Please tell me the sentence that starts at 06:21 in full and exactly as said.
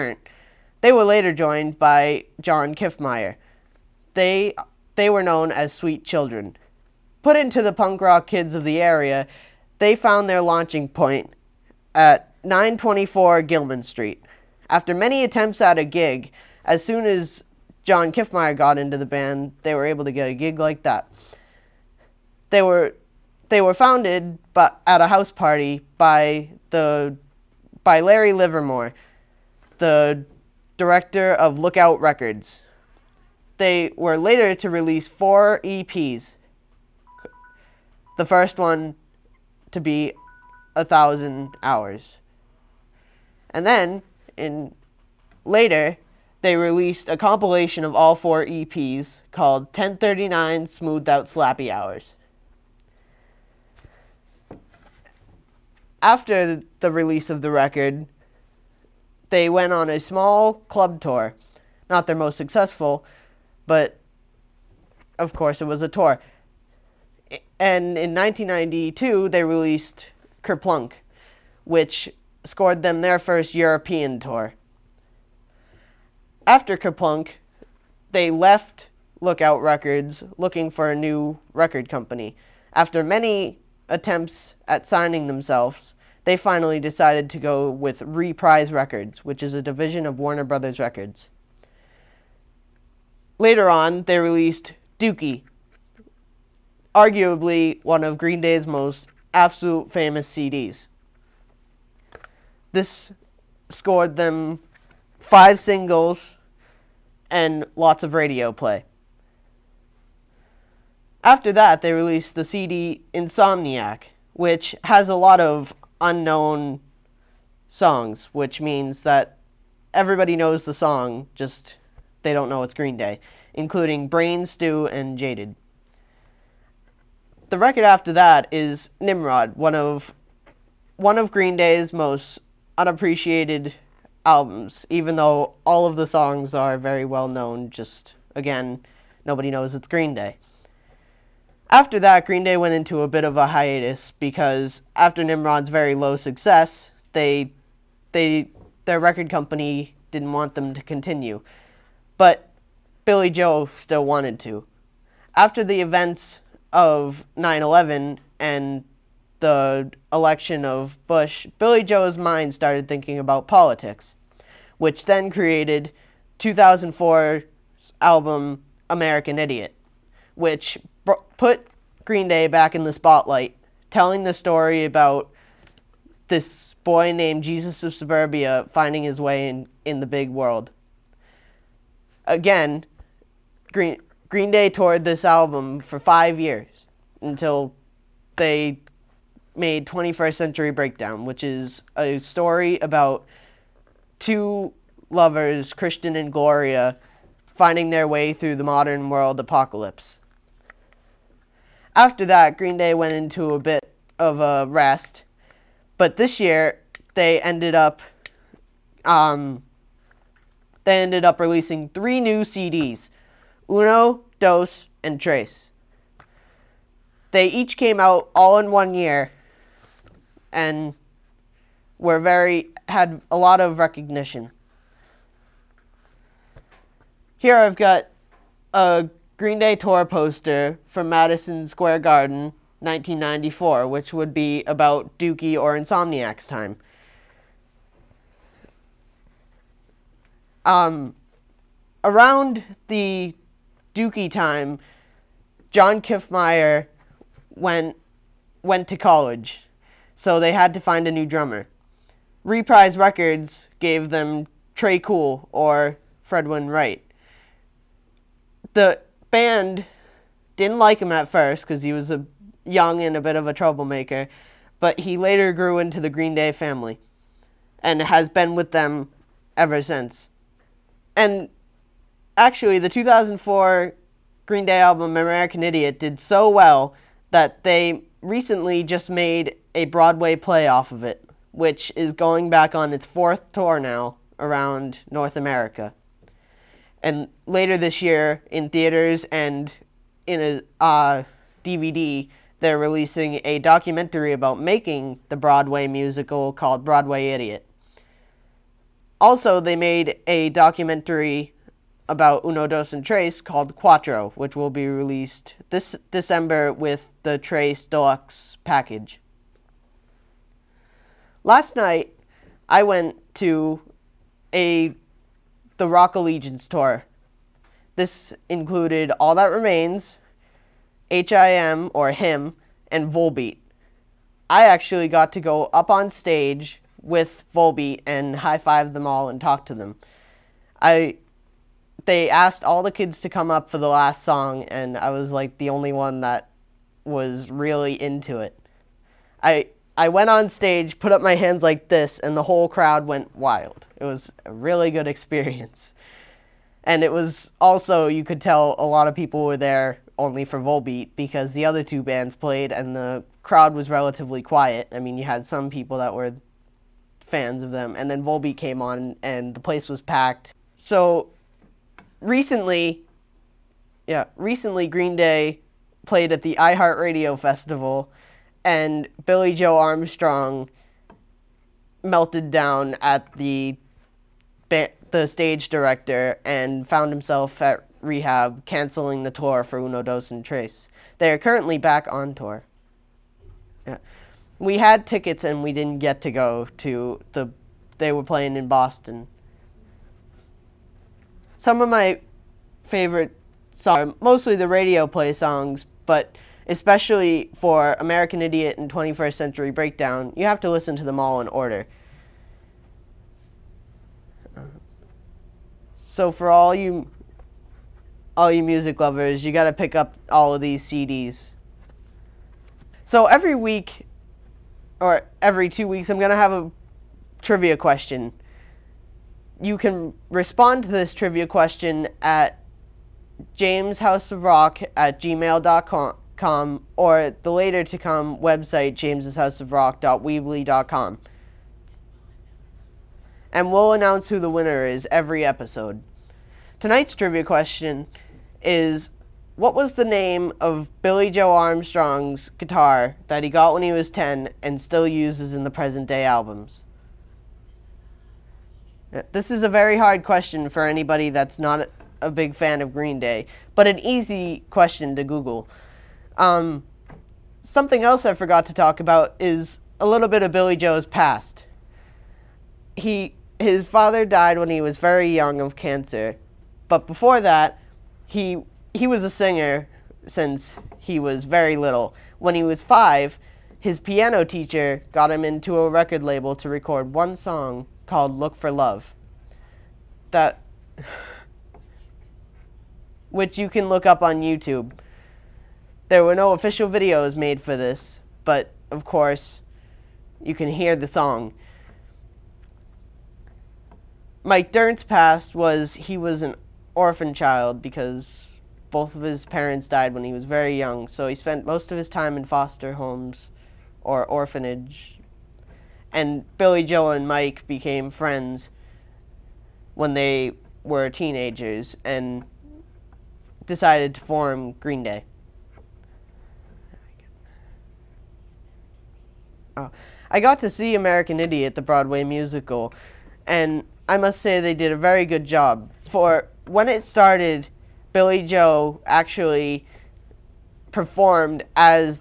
They are currently back on tour.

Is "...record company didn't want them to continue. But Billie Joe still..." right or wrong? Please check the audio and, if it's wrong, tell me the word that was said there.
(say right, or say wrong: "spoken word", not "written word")
right.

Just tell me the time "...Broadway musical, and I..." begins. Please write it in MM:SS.
08:41.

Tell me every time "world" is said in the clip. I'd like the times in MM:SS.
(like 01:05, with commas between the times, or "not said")
03:00, 03:19.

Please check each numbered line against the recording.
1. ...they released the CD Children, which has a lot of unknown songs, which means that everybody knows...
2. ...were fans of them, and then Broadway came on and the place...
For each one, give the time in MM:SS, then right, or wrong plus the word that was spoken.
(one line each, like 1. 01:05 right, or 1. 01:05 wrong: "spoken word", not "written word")
1. 01:51 wrong: "Insomniac", not "Children"
2. 05:56 wrong: "Volbeat", not "Broadway".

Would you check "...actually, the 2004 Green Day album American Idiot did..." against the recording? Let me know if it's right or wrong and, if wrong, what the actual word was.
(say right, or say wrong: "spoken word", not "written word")
right.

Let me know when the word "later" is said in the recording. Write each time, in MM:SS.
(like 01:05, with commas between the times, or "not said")
00:01, 00:34, 00:45, 01:33, 04:25, 04:47, 07:07.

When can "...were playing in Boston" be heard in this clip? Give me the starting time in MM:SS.
06:28.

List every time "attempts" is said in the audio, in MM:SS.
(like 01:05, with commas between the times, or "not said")
00:15, 01:23.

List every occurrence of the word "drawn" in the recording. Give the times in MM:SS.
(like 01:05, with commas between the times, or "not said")
not said.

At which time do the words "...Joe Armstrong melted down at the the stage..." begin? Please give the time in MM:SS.
06:09.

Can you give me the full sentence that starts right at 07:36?
Um, something else I forgot to talk about is a little bit of Billie Joe's past.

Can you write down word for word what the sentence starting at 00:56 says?
After the release of the record, they went on a small club tour.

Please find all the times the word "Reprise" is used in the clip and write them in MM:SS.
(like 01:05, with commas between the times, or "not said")
01:28, 04:12.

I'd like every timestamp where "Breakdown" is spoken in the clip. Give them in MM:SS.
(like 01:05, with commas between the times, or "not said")
03:10, 06:39.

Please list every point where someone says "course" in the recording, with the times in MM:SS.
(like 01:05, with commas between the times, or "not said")
01:05, 08:09.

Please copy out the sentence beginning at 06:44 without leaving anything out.
Uh, so for all you all you music lovers, you got to pick up all of these CDs.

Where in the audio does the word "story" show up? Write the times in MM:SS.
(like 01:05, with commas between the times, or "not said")
02:54, 03:12.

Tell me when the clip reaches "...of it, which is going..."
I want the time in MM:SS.
04:40.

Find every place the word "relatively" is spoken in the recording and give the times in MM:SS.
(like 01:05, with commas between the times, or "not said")
05:53.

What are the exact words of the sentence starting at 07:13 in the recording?
And we'll announce who the winner is every episode.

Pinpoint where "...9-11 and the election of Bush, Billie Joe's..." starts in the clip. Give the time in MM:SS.
02:37.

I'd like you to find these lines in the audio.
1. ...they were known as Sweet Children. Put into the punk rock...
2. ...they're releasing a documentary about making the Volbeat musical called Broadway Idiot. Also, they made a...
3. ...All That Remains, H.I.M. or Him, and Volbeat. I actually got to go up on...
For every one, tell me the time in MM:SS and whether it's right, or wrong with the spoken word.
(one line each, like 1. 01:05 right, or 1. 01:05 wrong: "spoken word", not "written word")
1. 00:04 right
2. 04:52 wrong: "Broadway", not "Volbeat"
3. 05:19 right.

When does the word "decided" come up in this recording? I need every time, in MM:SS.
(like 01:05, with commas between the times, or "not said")
01:26, 08:33.